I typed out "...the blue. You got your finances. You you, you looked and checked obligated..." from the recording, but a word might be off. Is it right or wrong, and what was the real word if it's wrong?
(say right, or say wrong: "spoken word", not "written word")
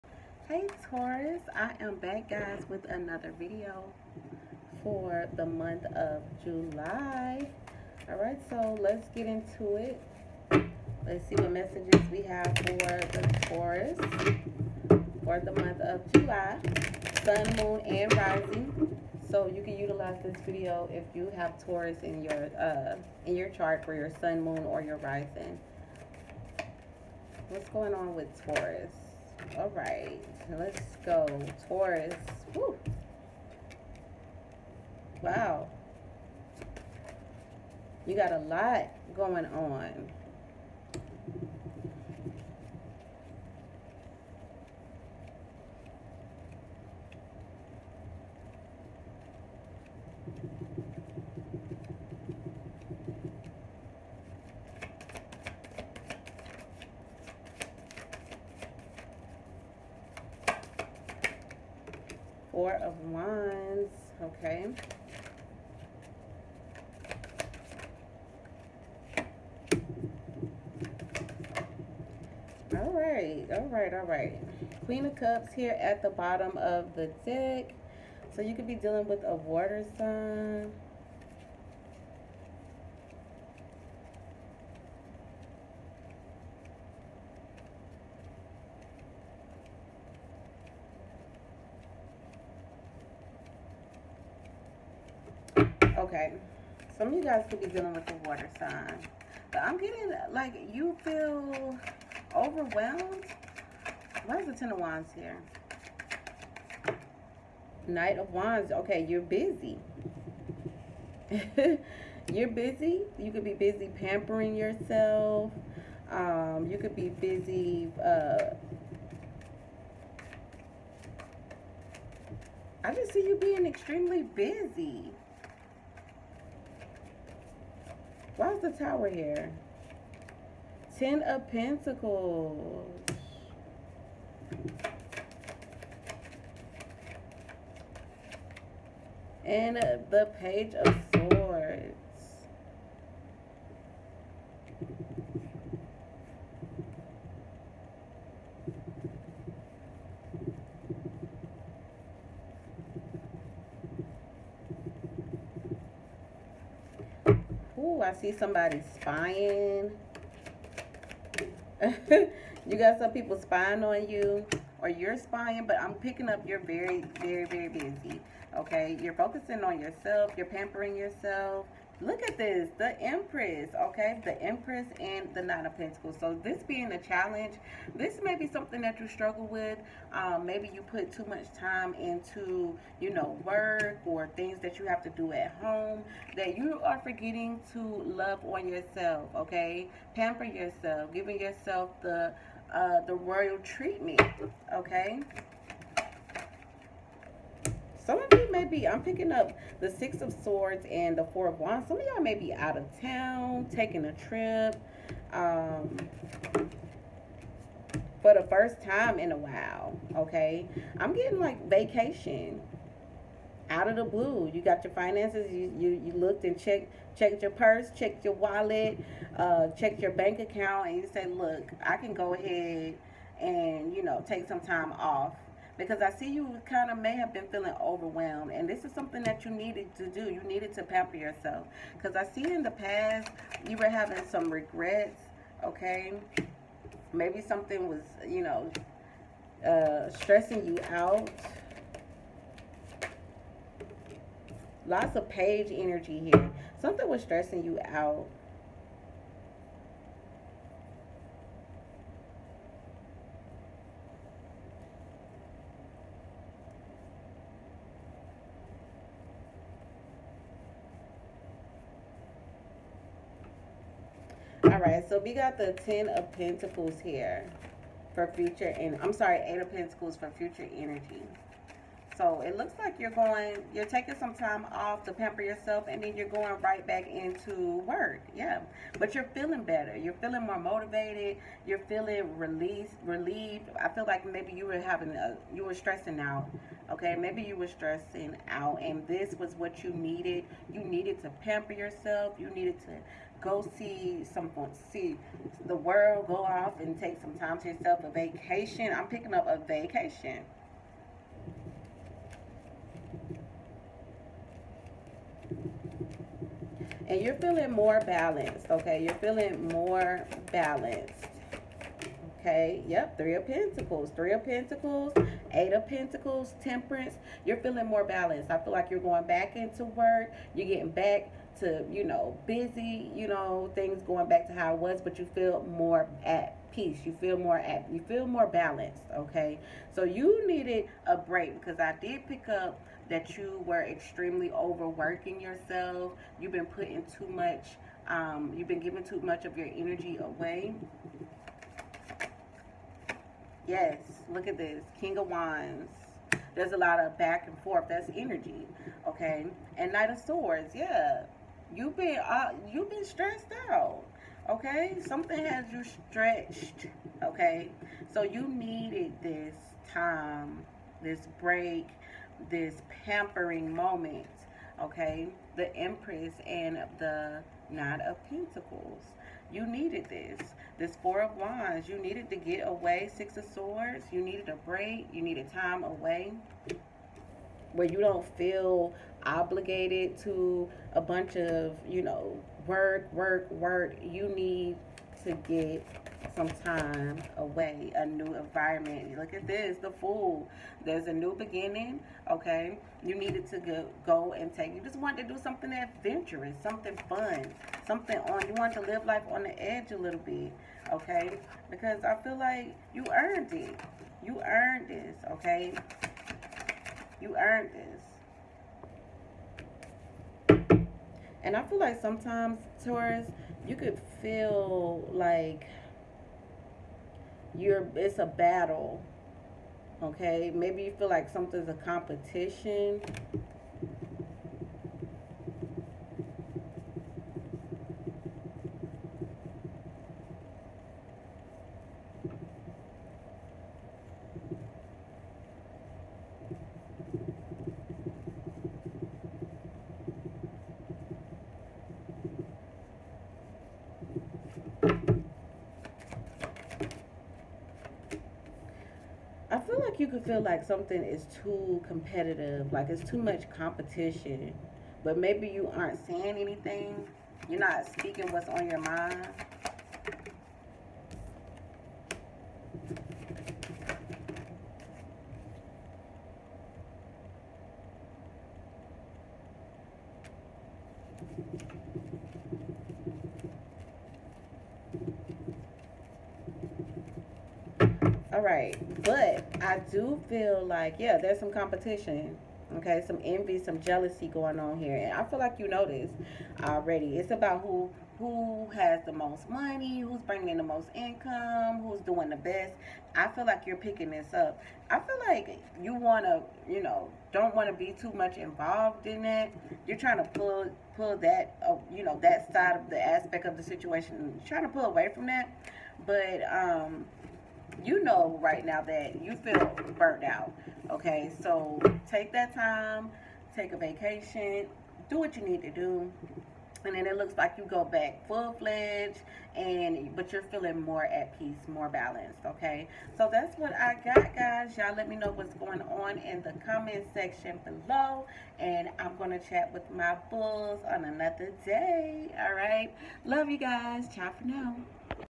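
wrong: "checked", not "obligated".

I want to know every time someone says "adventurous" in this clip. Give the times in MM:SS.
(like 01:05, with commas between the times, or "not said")
06:35.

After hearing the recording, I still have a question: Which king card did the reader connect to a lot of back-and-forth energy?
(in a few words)
King of Wands.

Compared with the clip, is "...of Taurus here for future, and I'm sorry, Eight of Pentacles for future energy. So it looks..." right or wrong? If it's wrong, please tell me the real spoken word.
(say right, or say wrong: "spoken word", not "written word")
wrong: "Pentacles", not "Taurus".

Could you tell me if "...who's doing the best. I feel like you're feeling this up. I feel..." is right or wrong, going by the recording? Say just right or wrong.
wrong.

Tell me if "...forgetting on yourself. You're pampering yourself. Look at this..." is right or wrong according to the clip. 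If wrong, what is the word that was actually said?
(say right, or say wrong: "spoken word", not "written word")
wrong: "focusing", not "forgetting".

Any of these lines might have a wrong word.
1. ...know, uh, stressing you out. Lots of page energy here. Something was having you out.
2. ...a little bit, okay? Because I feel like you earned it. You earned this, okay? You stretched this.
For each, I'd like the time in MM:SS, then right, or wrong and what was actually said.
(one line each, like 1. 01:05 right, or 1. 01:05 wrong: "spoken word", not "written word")
1. 03:58 wrong: "stressing", not "having"
2. 06:39 wrong: "earned", not "stretched".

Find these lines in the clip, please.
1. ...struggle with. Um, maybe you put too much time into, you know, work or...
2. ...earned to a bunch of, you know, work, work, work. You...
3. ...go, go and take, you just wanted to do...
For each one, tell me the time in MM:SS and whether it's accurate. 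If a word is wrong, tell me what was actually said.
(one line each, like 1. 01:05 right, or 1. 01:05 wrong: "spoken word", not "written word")
1. 02:59 right
2. 06:19 wrong: "obligated", not "earned"
3. 06:33 right.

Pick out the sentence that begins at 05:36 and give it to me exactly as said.
You've been putting too much, um, you've been giving too much of your energy away.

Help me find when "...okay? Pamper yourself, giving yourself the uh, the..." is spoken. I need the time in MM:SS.
03:09.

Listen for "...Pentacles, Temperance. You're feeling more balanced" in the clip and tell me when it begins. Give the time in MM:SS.
05:15.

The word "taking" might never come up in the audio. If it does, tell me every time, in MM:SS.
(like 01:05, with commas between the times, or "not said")
03:23, 04:33.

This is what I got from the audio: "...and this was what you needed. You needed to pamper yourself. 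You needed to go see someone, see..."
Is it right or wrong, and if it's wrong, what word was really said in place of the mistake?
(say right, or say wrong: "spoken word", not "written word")
right.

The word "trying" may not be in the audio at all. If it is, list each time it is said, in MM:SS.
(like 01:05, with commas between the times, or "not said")
08:19, 08:24.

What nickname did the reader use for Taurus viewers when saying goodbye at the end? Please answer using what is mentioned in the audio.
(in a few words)
bulls.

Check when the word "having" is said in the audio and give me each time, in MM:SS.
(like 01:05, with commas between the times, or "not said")
03:53, 04:44.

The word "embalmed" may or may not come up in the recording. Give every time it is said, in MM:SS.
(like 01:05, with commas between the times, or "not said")
not said.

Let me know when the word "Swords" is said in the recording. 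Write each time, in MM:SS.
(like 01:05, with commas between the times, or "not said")
02:21, 03:20, 05:50, 06:13.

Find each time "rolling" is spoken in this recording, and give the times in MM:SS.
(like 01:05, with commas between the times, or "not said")
not said.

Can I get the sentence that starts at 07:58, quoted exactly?
All right, but I do feel like, yeah, there's some competition.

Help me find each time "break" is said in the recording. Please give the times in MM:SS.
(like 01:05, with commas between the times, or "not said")
05:31, 06:01, 06:14.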